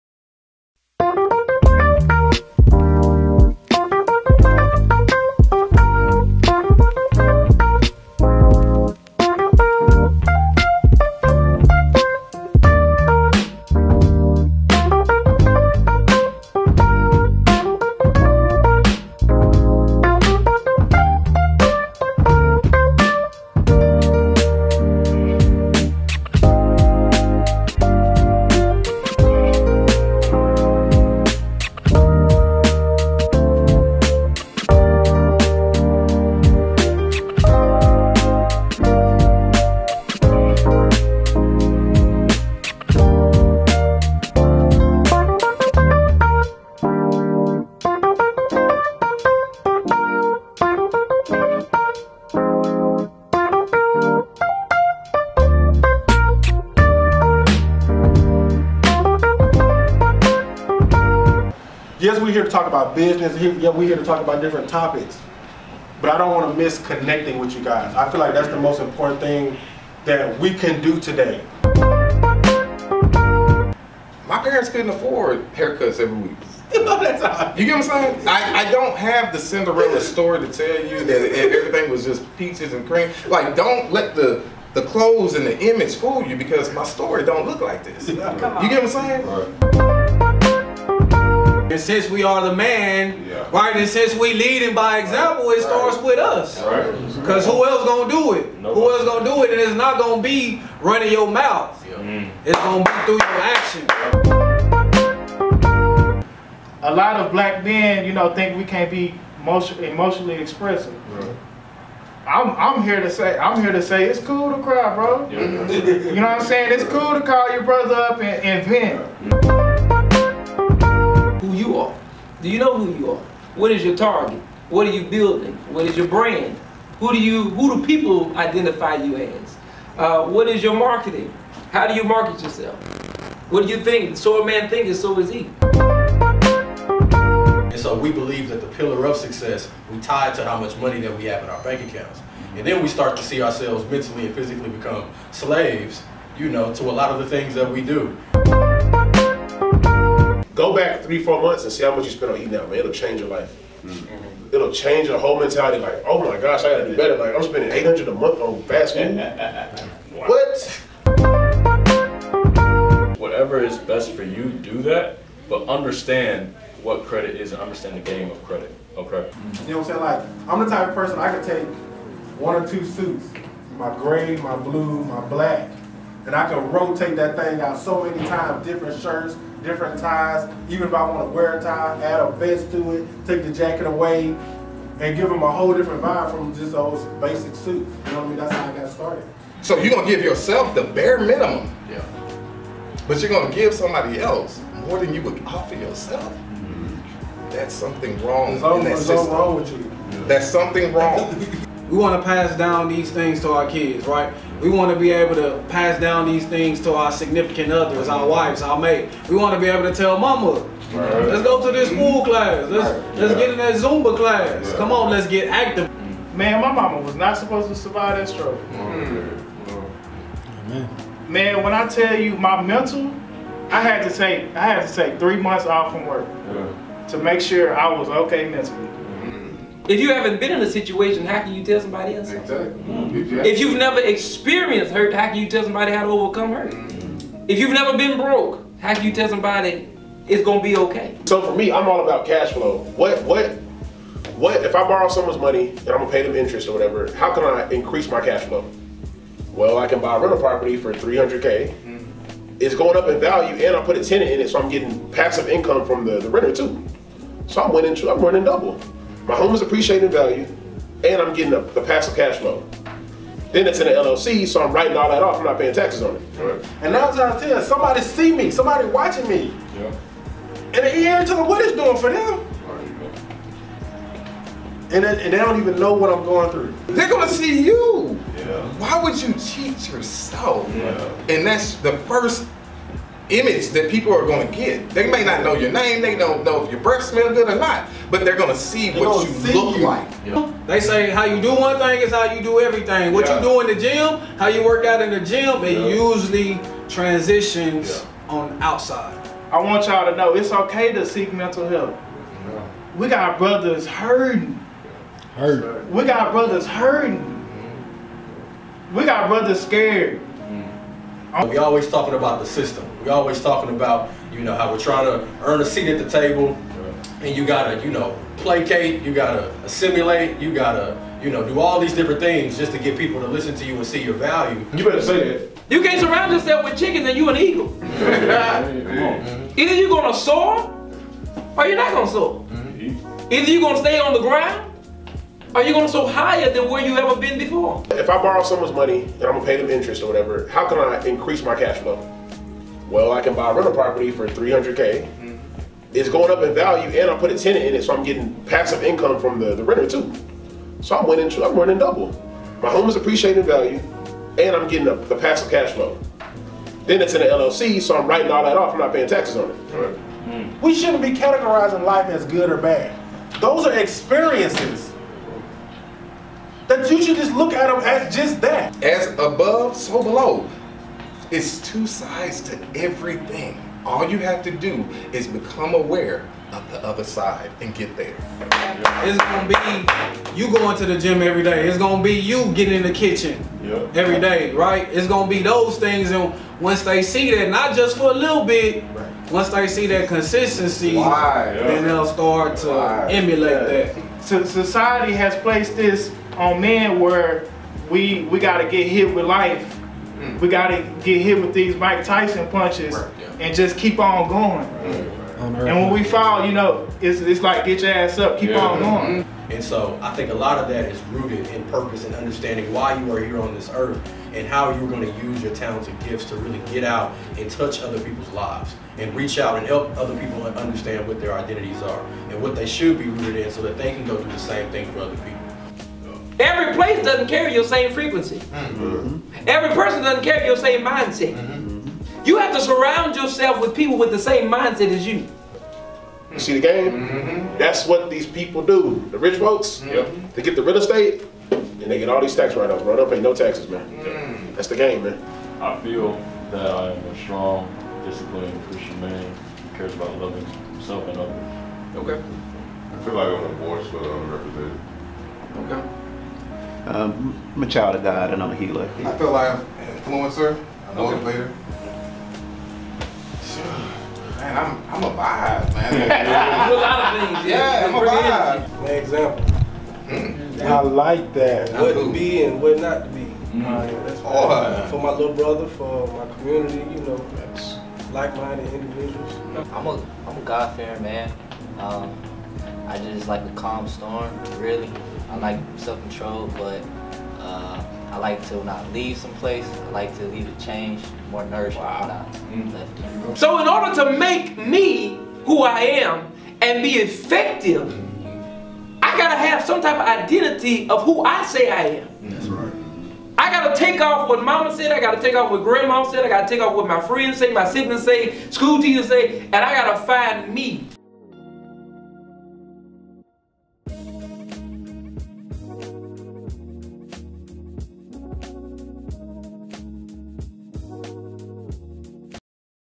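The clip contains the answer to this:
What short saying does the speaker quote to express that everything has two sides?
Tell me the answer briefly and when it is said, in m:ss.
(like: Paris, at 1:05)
As above, so below, at 6:08.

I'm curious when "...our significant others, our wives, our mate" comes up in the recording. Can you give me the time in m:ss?
3:26.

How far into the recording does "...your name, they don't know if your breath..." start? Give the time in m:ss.
4:45.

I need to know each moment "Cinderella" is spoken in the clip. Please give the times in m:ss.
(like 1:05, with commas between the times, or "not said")
1:19.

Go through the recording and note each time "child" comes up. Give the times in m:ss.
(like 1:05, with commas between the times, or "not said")
7:37.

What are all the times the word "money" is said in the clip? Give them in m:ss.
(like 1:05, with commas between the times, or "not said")
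2:20, 4:05, 5:38.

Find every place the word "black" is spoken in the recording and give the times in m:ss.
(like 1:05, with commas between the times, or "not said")
1:47, 2:55.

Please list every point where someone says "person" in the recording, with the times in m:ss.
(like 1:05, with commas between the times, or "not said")
2:50, 7:09.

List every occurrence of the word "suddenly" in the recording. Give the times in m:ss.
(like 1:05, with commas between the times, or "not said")
not said.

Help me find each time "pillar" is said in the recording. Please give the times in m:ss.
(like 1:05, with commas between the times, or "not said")
2:18.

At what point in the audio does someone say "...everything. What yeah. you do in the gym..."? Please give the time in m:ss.
4:52.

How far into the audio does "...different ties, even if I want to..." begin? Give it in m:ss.
2:59.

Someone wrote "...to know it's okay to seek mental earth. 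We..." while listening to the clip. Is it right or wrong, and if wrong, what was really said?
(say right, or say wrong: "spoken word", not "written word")
wrong: "health", not "earth".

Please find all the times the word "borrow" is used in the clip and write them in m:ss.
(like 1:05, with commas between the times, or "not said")
4:04, 5:38.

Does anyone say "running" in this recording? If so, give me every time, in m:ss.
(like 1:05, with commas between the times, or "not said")
1:40, 4:18.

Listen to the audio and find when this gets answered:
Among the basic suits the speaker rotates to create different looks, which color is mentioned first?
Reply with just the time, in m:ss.
2:53.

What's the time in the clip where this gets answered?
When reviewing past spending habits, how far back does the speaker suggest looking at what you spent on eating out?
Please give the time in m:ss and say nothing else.
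2:31.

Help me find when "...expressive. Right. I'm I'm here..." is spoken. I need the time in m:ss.
1:50.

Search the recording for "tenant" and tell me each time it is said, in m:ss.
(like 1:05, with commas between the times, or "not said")
4:14, 5:47.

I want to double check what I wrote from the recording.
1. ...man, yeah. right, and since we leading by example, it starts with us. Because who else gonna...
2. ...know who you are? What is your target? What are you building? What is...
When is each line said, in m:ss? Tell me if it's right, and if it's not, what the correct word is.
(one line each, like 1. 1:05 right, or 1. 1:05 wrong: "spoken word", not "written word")
1. 1:32 right
2. 2:02 right.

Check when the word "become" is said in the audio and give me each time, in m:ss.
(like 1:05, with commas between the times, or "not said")
2:24, 6:15.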